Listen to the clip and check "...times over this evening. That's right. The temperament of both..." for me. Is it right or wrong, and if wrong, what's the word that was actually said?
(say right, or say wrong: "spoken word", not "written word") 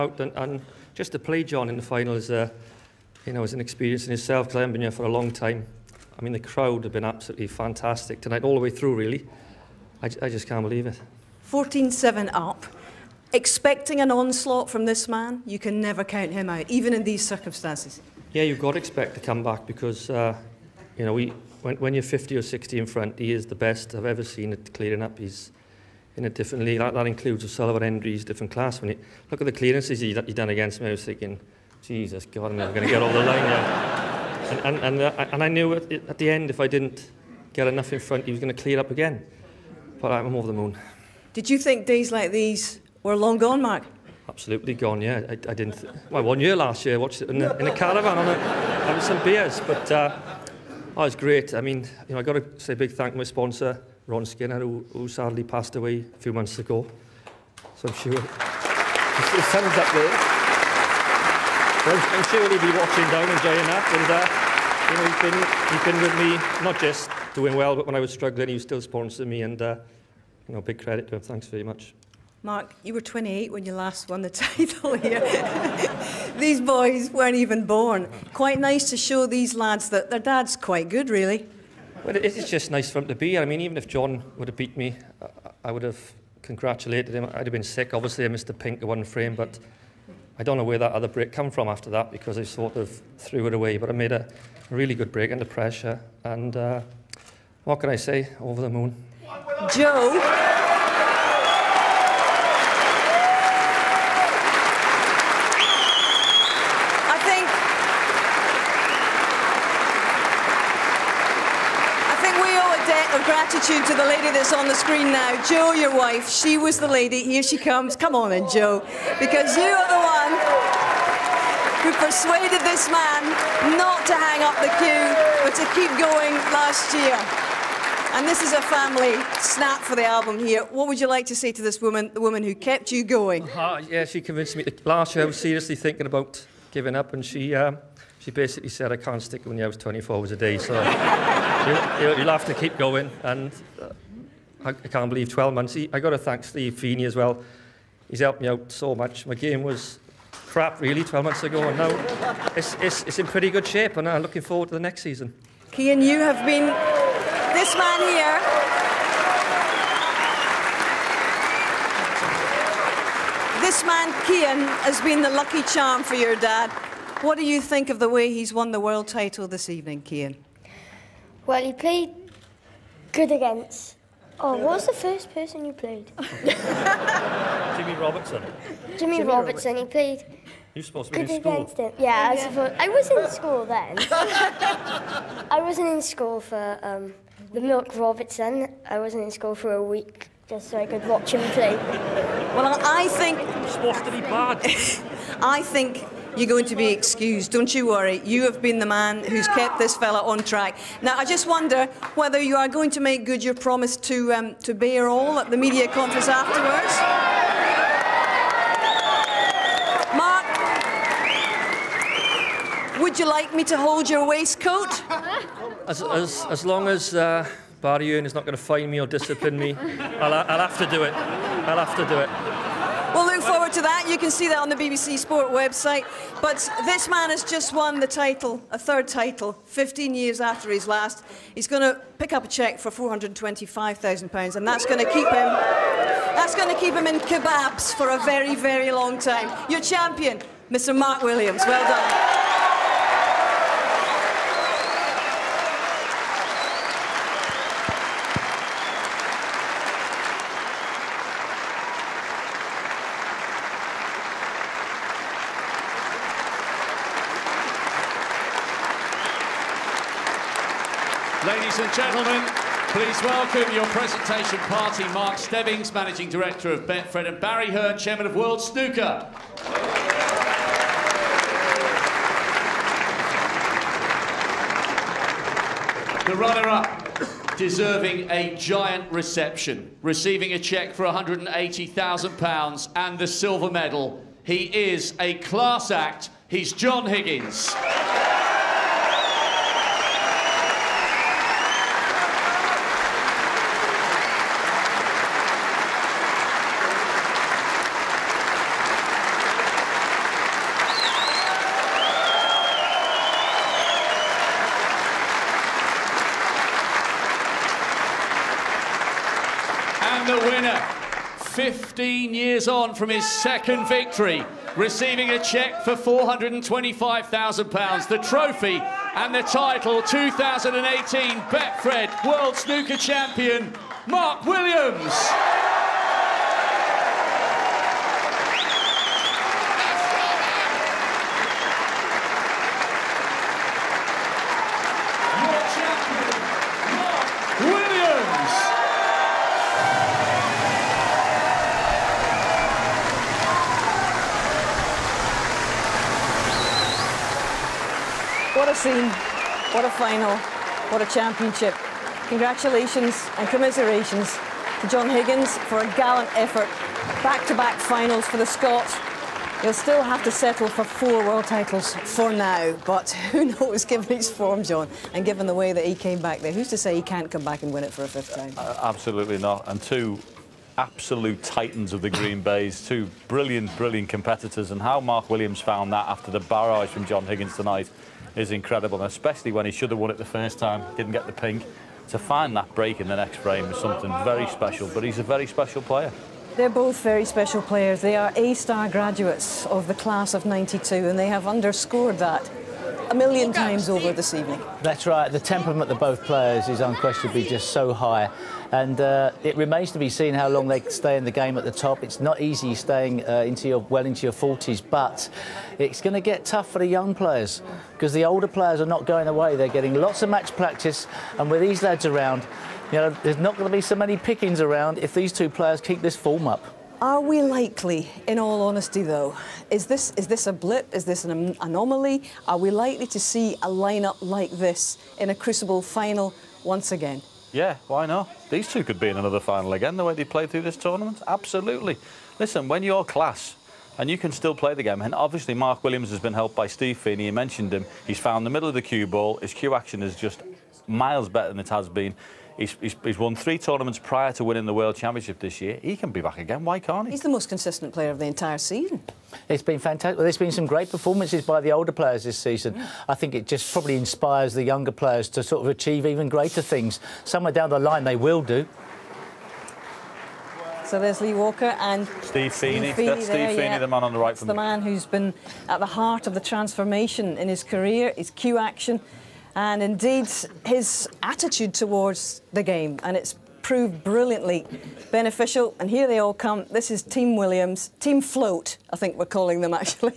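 right.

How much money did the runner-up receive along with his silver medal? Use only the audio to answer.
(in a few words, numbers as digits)
£180,000.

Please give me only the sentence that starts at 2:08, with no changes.
And this is a family snap for the album here.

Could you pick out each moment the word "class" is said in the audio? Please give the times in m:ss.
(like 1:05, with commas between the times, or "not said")
0:28, 4:45, 6:29, 7:13.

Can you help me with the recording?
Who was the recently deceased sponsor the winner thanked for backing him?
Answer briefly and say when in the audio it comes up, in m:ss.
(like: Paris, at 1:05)
Ron Skinner, at 0:54.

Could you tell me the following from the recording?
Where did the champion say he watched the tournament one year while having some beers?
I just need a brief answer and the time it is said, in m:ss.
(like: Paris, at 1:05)
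In a caravan, at 0:47.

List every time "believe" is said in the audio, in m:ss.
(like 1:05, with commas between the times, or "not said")
0:10, 2:25.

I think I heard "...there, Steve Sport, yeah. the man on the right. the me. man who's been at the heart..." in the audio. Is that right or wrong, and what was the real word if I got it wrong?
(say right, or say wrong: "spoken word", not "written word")
wrong: "Feeney", not "Sport".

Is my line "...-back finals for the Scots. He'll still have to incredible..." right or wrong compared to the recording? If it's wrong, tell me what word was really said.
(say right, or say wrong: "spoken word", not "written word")
wrong: "settle", not "incredible".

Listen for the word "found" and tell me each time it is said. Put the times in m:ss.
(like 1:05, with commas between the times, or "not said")
6:15, 7:18.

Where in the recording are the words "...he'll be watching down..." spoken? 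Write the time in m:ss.
1:02.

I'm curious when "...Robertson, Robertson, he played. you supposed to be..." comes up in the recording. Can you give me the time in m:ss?
2:59.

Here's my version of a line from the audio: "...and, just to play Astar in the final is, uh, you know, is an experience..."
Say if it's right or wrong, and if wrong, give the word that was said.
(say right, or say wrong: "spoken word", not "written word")
wrong: "John", not "Astar".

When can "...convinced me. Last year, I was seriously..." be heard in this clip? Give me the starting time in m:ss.
2:14.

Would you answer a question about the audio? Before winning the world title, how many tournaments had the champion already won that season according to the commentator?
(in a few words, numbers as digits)
3.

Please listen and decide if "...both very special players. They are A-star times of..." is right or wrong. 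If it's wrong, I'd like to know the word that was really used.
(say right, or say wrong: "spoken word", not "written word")
wrong: "graduates", not "times".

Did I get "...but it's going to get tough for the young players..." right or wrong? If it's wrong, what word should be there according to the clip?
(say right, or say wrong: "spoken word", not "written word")
right.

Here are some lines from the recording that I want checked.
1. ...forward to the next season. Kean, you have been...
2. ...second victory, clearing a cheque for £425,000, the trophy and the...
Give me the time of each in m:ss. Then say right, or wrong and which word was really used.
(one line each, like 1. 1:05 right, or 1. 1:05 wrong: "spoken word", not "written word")
1. 2:34 right
2. 5:13 wrong: "receiving", not "clearing".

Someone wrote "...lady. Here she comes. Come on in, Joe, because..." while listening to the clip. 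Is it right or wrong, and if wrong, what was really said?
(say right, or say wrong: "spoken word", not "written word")
right.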